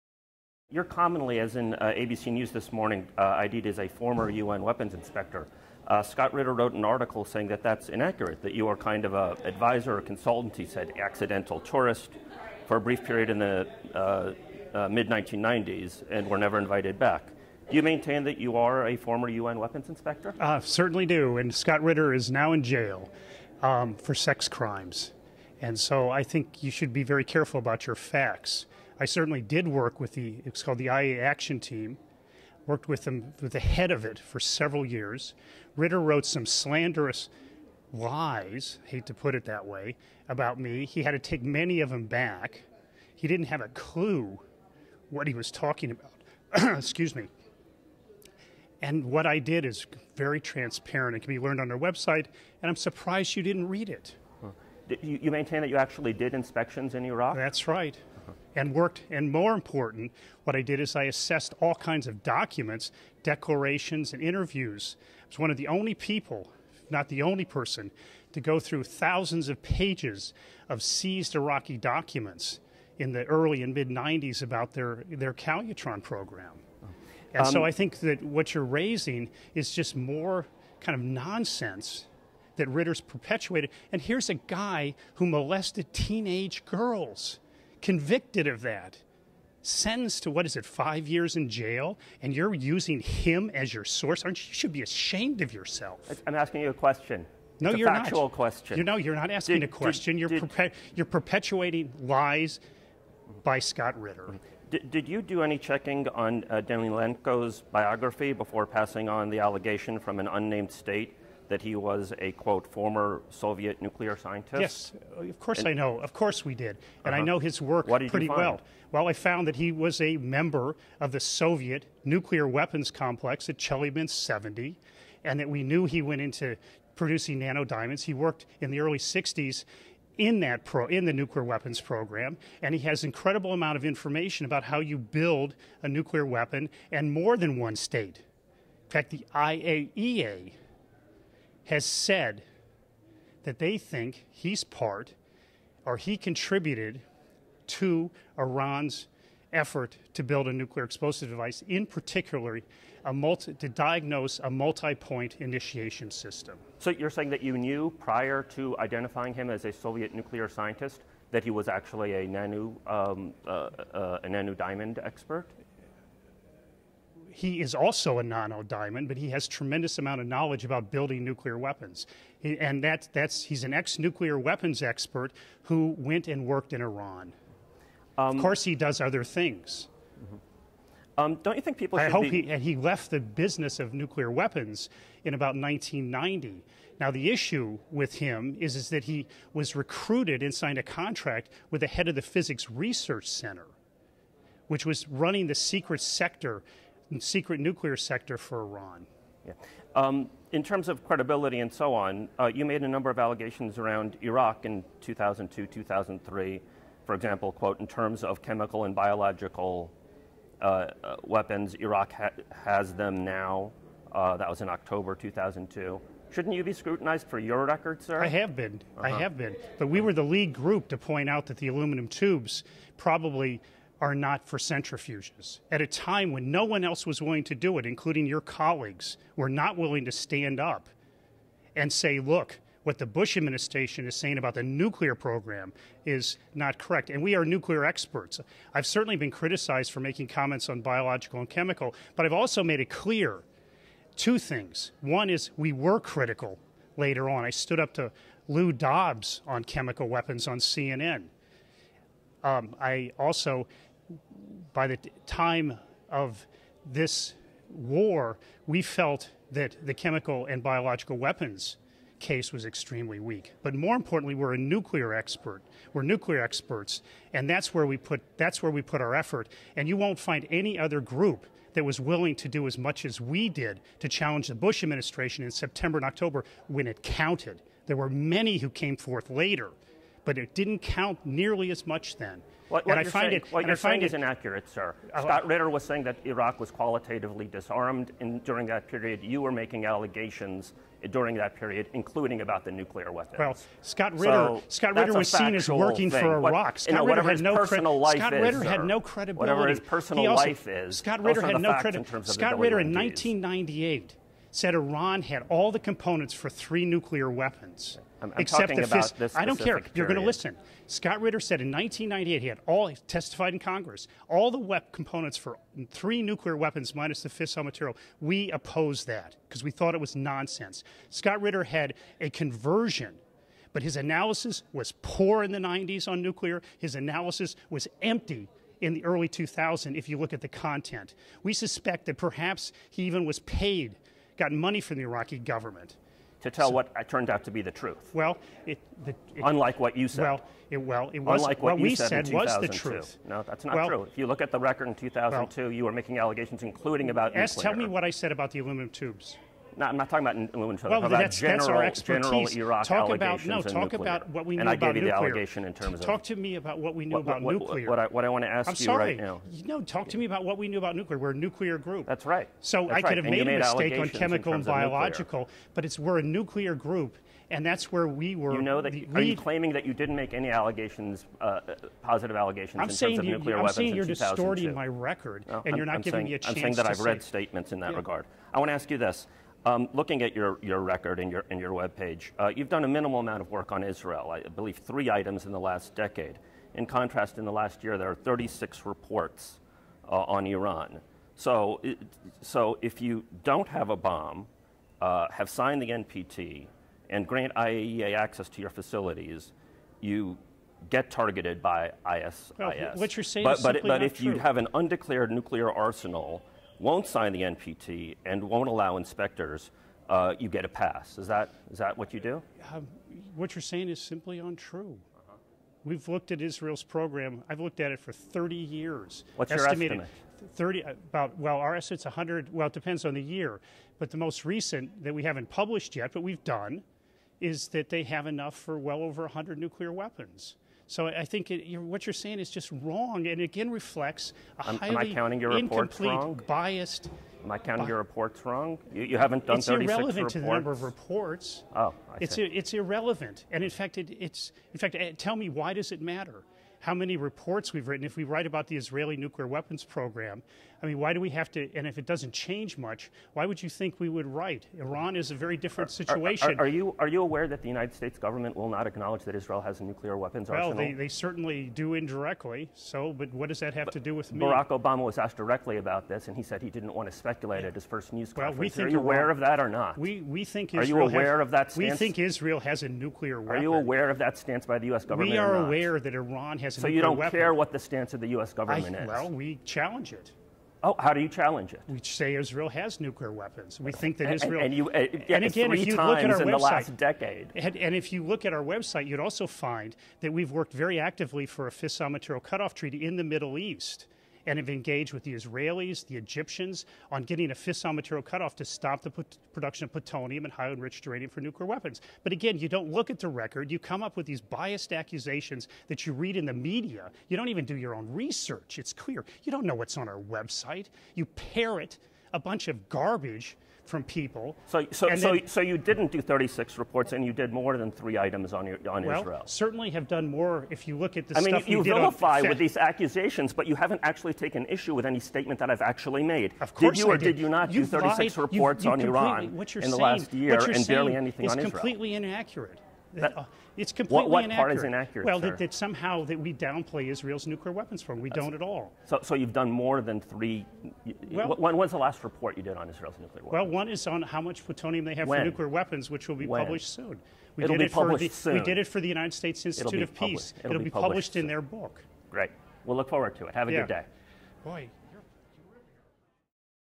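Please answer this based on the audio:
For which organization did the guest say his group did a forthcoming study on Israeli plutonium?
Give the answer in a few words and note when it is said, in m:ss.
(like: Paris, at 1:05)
United States Institute of Peace, at 9:09.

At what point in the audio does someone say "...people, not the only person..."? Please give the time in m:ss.
1:05.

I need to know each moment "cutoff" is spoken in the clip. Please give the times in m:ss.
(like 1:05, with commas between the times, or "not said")
8:12, 8:18.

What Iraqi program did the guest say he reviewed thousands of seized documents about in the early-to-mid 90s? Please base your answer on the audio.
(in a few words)
Calutron program.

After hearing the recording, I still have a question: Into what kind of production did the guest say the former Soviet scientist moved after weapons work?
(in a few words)
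nano diamonds.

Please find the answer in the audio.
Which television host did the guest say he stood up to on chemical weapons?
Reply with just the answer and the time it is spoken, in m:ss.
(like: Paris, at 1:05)
Lou Dobbs, at 4:08.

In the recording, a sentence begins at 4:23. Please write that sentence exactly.
But more importantly, we're a nuclear expert.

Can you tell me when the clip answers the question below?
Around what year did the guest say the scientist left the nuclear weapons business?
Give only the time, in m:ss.
3:05.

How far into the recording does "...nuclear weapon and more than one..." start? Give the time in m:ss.
2:15.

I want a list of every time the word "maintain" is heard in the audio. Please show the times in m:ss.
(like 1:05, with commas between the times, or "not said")
0:17, 0:55.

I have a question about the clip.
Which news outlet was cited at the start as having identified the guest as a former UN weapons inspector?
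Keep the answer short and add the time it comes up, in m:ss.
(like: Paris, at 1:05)
ABC News, at 0:01.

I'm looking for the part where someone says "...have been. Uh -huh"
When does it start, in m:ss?
3:38.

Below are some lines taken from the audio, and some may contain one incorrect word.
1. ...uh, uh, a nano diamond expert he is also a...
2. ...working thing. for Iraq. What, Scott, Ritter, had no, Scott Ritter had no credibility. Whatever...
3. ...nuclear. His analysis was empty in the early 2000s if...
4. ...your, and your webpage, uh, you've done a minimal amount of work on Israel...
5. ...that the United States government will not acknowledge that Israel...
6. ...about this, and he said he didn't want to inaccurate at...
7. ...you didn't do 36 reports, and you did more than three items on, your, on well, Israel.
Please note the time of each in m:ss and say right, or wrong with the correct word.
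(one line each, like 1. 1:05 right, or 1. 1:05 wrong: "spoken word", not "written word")
1. 2:43 right
2. 4:55 right
3. 5:26 right
4. 6:21 right
5. 7:37 right
6. 7:45 wrong: "speculate", not "inaccurate"
7. 8:35 right.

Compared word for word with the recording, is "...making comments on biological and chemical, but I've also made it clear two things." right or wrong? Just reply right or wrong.
right.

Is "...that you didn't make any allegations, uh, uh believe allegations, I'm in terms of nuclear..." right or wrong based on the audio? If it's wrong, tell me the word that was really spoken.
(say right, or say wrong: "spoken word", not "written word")
wrong: "positive", not "believe".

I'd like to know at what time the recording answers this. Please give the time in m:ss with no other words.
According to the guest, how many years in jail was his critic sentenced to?
1:30.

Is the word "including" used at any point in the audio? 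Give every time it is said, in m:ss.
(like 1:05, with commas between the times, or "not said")
3:47, 4:51, 5:46.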